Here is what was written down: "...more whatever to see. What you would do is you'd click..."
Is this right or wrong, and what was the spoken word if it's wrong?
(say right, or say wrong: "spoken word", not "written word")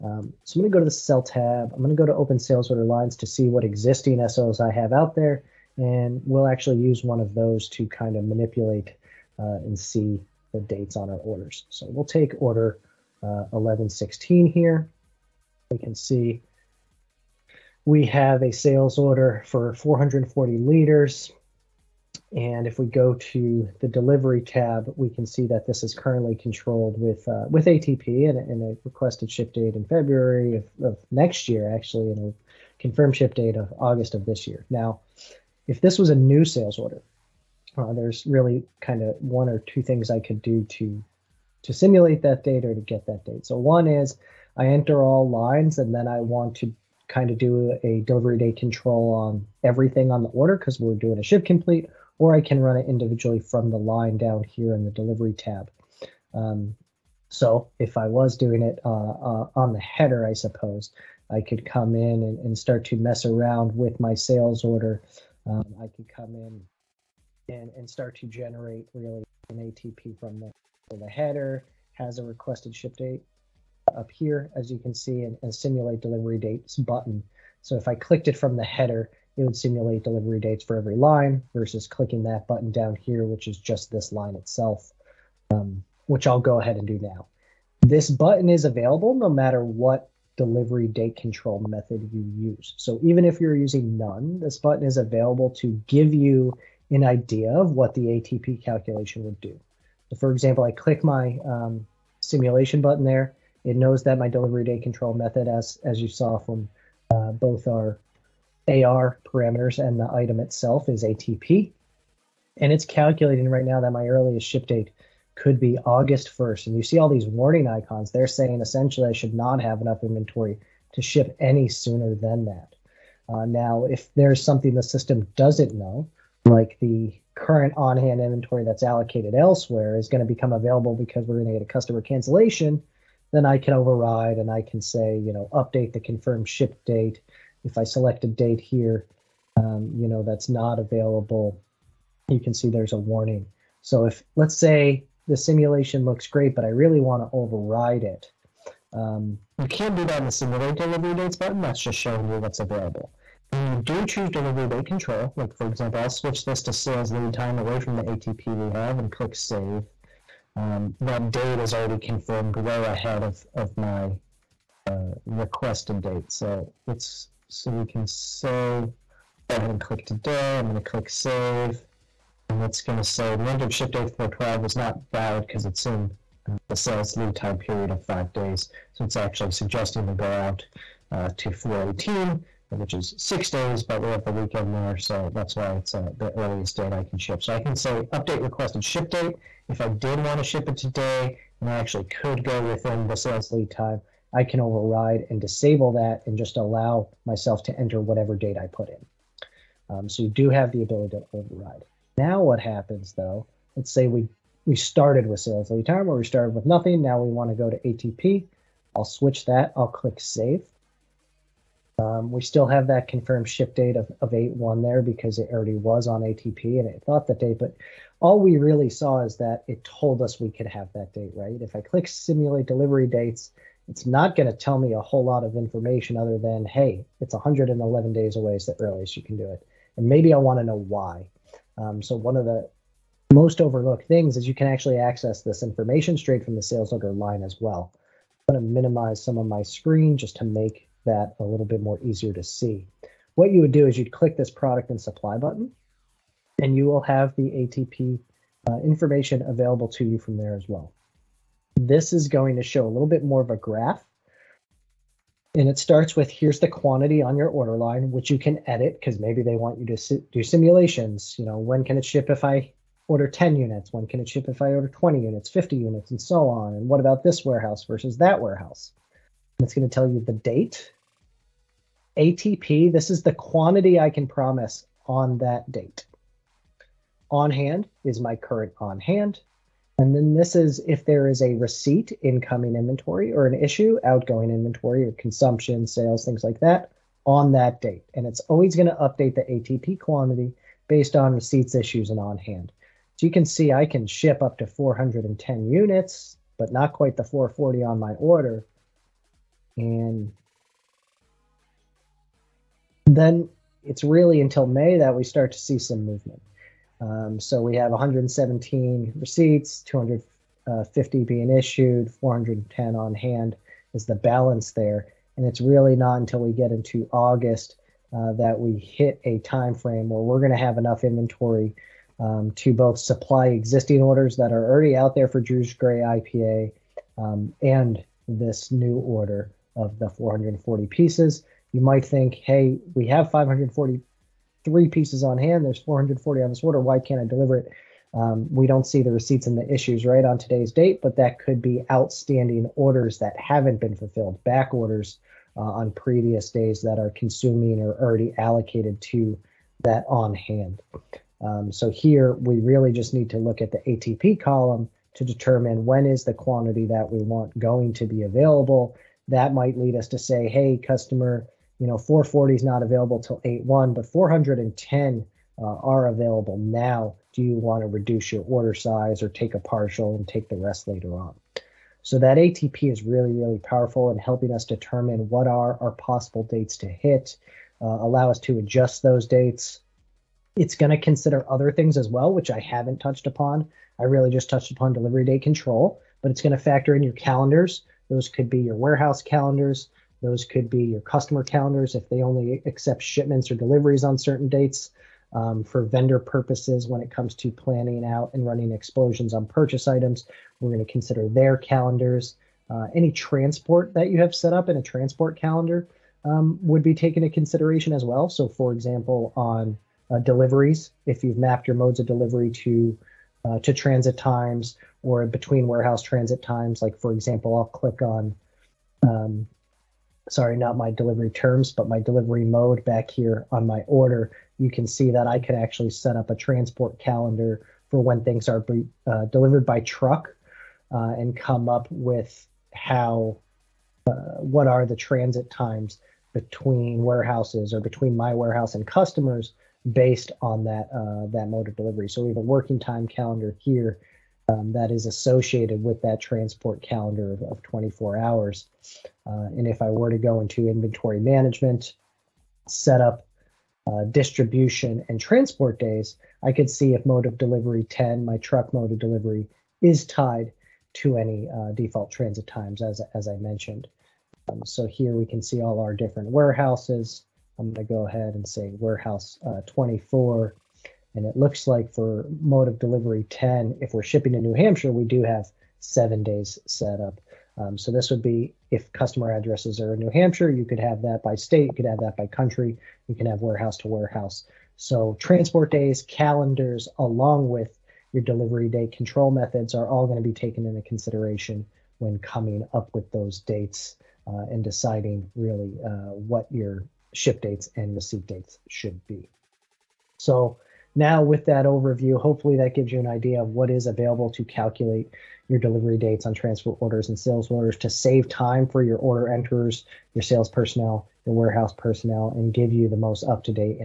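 wrong: "easier", not "whatever".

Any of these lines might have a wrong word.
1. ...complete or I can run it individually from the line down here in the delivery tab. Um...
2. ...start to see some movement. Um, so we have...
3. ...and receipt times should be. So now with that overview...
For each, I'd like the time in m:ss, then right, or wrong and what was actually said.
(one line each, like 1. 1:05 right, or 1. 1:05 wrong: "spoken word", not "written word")
1. 0:51 right
2. 5:05 right
3. 8:17 wrong: "dates", not "times".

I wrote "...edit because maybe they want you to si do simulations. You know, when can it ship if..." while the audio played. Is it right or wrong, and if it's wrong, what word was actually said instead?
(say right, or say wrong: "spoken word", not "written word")
right.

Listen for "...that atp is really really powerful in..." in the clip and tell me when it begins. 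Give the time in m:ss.
6:12.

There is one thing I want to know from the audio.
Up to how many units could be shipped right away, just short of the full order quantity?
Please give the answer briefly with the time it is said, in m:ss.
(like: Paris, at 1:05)
410, at 4:54.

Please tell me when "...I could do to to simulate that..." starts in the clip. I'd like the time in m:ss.
0:40.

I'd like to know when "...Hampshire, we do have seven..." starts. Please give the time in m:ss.
7:54.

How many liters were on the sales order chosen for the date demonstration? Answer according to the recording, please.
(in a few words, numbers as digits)
440 liters.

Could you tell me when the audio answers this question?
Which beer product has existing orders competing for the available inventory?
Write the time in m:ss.
5:25.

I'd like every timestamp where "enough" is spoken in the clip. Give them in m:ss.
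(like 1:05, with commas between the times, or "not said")
1:59, 5:20.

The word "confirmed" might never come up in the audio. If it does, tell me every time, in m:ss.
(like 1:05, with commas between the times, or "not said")
0:32, 2:16, 2:41, 3:33.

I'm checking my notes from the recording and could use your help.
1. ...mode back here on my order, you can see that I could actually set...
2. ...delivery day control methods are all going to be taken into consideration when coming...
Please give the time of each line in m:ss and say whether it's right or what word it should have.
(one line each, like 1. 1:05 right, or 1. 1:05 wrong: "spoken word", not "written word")
1. 7:02 right
2. 8:08 right.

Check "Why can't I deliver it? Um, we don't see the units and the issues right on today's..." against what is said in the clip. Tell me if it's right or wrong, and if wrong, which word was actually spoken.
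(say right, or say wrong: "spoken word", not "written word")
wrong: "receipts", not "units".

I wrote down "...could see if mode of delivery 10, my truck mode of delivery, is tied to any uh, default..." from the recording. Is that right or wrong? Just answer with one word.
right.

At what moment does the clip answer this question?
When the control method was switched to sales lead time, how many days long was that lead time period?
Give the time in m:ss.
2:58.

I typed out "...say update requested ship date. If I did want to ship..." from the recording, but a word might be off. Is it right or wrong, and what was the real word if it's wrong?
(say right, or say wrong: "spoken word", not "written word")
right.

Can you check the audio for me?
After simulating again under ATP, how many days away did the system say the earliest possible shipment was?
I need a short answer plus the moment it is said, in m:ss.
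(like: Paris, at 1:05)
111 days, at 3:47.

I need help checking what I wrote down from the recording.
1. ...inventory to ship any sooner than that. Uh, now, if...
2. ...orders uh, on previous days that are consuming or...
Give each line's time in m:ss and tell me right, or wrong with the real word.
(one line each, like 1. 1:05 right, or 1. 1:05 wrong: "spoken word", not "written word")
1. 2:00 right
2. 5:44 right.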